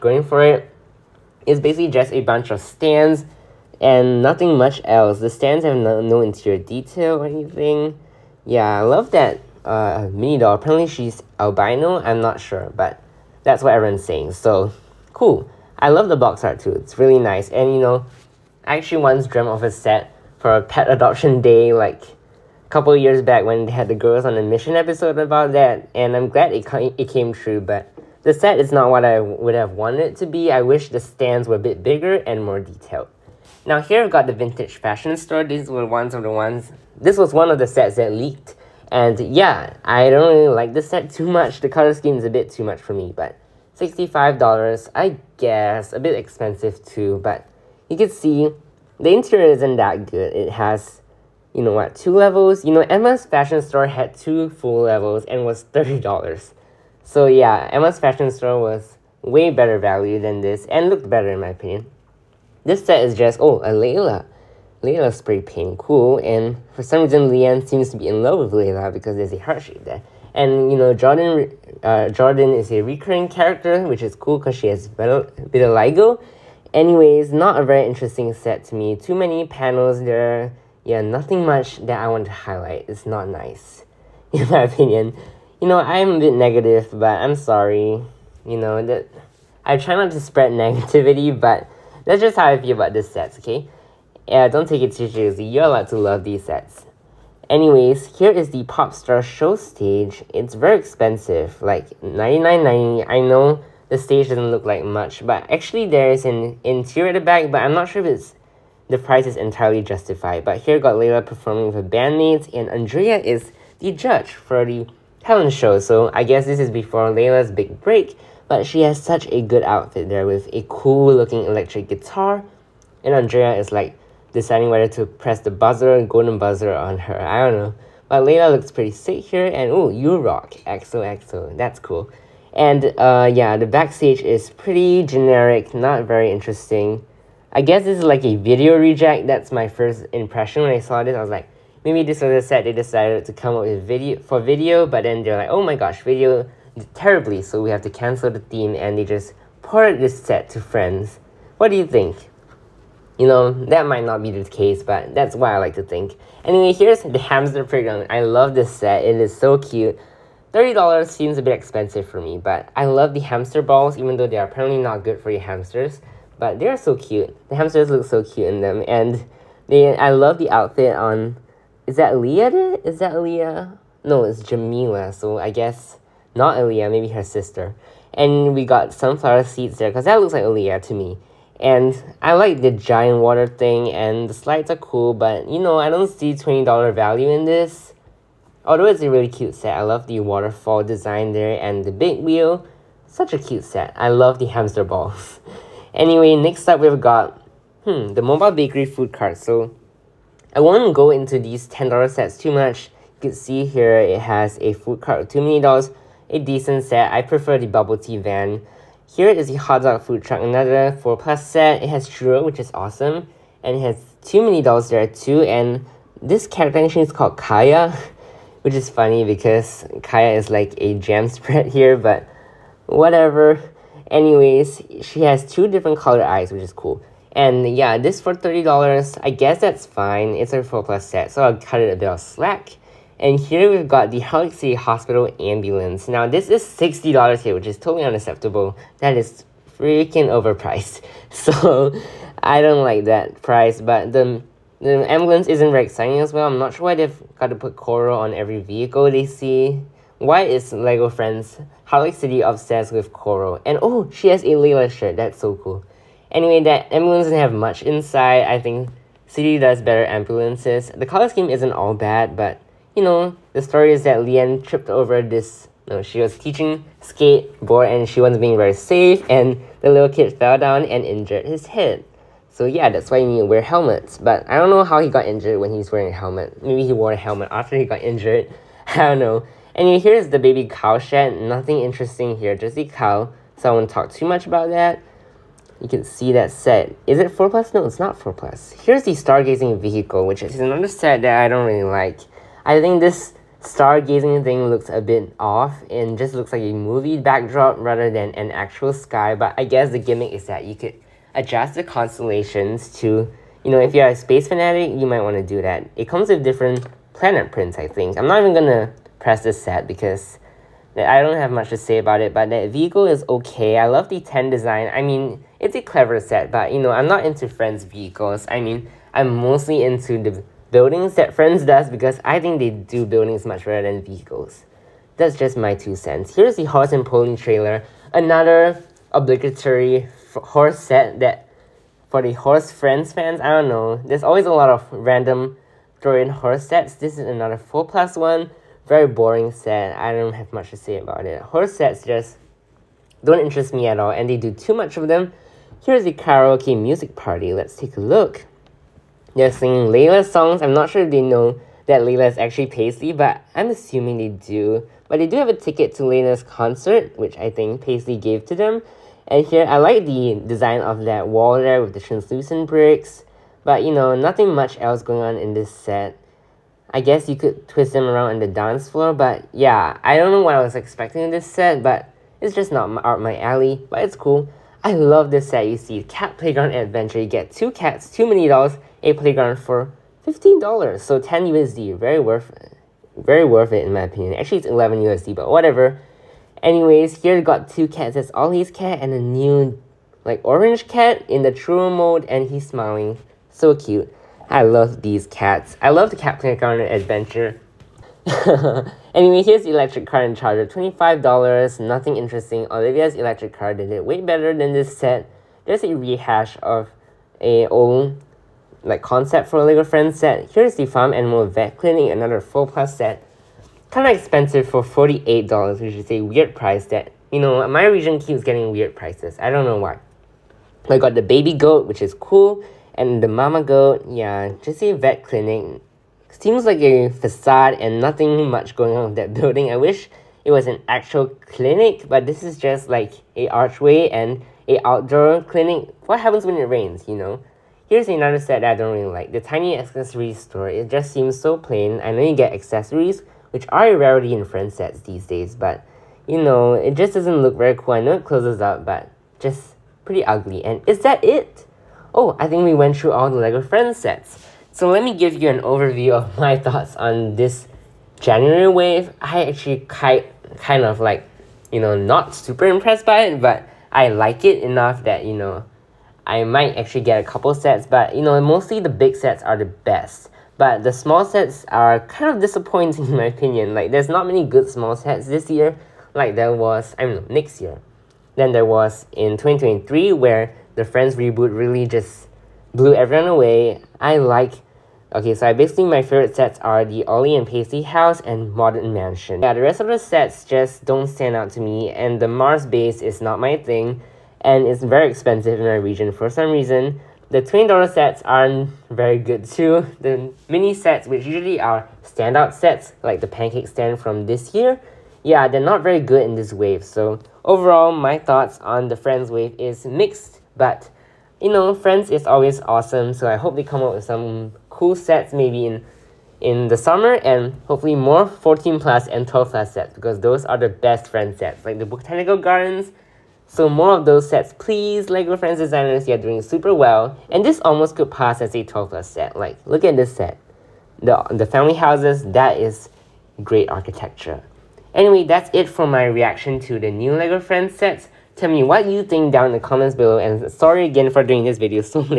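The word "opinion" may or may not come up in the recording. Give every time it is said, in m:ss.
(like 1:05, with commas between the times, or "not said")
1:01, 1:24, 6:24, 7:53.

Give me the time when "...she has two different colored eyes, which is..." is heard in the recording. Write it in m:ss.
3:45.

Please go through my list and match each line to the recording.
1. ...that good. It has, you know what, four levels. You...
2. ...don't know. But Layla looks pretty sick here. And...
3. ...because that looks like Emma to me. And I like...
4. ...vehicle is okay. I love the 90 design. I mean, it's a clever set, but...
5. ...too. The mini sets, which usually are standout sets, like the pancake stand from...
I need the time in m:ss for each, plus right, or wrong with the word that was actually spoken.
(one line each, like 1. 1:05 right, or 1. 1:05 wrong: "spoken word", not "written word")
1. 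0:49 wrong: "two", not "four"
2. 2:07 right
3. 2:59 wrong: "Aliya", not "Emma"
4. 5:12 wrong: "10", not "90"
5. 8:19 right.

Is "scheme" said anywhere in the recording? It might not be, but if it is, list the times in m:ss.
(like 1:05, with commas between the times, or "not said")
0:41, 4:21.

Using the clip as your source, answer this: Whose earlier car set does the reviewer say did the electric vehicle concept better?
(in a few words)
Olivia's.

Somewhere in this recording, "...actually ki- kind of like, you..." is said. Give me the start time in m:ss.
7:39.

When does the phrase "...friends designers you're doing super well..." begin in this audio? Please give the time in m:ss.
8:45.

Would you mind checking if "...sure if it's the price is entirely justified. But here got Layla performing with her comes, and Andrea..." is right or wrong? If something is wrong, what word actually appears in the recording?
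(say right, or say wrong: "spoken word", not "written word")
wrong: "bandmates", not "comes".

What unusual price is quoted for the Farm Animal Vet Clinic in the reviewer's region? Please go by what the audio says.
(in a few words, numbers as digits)
$48.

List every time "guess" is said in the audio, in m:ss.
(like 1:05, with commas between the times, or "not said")
0:45, 1:56, 2:17, 2:55, 3:49, 4:59, 6:07.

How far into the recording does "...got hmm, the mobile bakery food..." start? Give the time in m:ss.
3:16.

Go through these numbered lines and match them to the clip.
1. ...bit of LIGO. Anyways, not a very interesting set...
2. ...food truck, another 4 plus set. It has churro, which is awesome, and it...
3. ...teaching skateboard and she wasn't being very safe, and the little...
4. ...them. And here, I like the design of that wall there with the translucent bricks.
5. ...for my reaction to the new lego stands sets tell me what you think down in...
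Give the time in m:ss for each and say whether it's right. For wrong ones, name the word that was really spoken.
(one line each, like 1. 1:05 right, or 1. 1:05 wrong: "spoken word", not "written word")
1. 1:14 right
2. 3:30 right
3. 4:26 right
4. 5:58 right
5. 8:55 wrong: "friends", not "stands".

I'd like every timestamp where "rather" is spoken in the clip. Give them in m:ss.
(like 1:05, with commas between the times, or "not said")
4:57.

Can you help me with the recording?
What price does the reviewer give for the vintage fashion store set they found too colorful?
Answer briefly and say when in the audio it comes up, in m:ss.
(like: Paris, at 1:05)
$65, at 0:43.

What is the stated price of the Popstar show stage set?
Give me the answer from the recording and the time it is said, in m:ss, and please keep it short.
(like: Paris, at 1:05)
99.90, at 1:42.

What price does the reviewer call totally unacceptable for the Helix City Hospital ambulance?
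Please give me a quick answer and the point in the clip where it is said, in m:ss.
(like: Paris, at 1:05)
$60, at 3:56.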